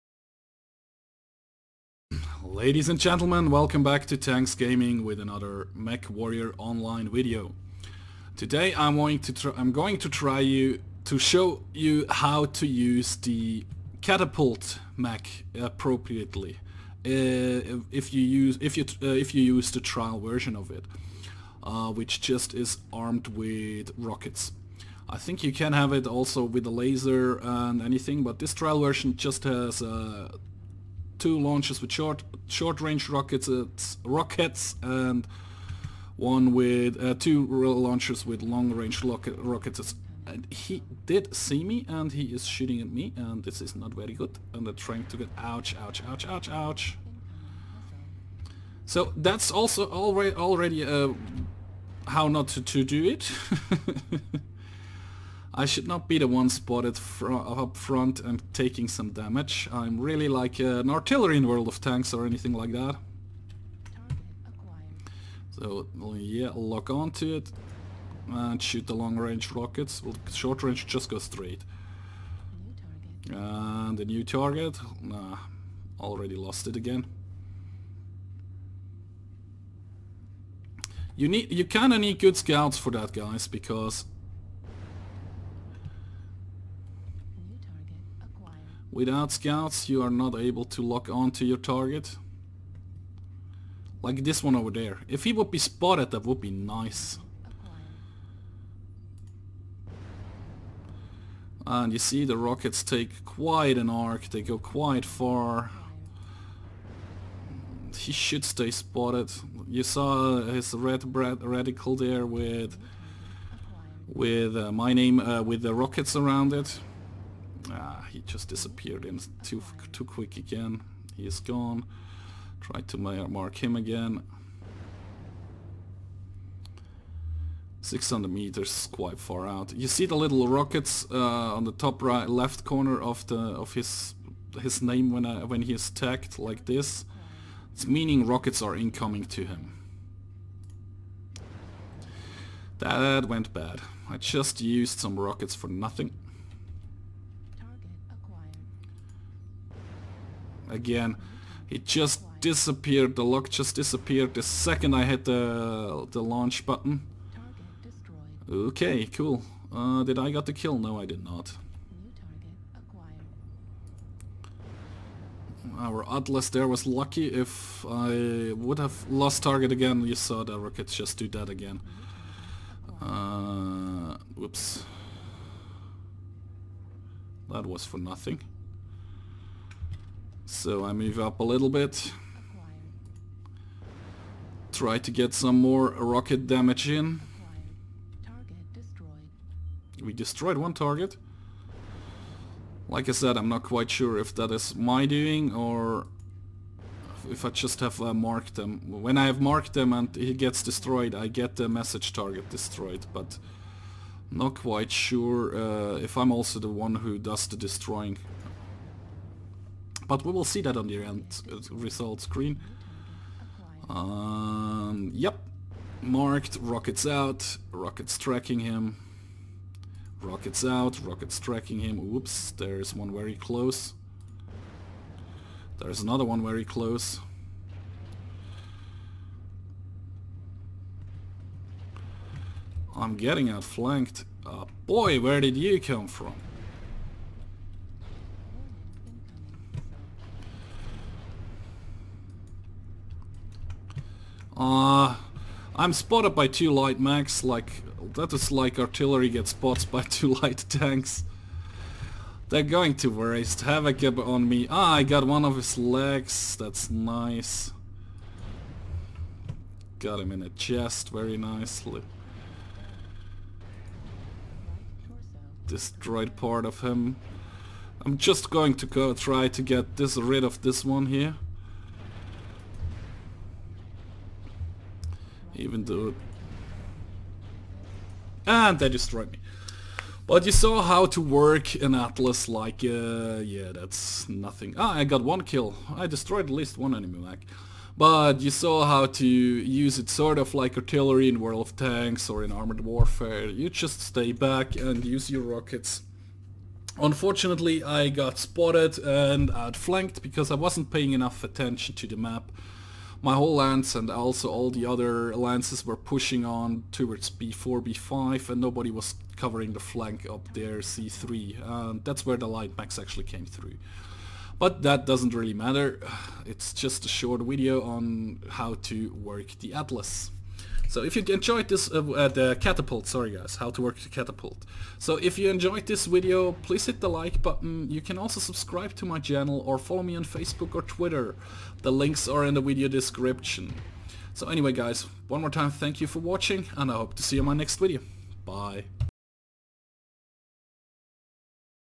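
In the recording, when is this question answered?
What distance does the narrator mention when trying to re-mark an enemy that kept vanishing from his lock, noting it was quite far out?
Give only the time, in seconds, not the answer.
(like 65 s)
127 s.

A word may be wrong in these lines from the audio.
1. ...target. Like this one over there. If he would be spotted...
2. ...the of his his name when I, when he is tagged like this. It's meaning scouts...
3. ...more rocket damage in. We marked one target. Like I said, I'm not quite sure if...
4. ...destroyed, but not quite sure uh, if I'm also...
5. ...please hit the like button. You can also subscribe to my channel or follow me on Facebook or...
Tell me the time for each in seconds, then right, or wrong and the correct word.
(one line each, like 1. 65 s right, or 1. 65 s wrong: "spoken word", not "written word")
1. 91 s right
2. 133 s wrong: "rockets", not "scouts"
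3. 185 s wrong: "destroyed", not "marked"
4. 202 s right
5. 326 s right.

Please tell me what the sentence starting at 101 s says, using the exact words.
And you see the rockets take quite an arc, they go quite far.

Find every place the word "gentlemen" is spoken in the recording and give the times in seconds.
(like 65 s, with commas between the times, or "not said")
2 s.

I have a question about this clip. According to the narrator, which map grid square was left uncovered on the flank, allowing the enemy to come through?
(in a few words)
C3.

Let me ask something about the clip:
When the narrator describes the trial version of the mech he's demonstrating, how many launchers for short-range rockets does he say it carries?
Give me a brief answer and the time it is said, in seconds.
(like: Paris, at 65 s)
2, at 31 s.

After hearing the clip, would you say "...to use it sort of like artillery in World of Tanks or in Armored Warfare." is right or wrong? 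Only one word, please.
right.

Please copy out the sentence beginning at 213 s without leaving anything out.
Um, yep, marked, rockets out, rockets tracking him.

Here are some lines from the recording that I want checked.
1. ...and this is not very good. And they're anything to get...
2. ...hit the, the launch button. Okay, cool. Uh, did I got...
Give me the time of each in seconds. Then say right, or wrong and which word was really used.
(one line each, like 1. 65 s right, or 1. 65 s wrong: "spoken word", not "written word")
1. 43 s wrong: "trying", not "anything"
2. 155 s right.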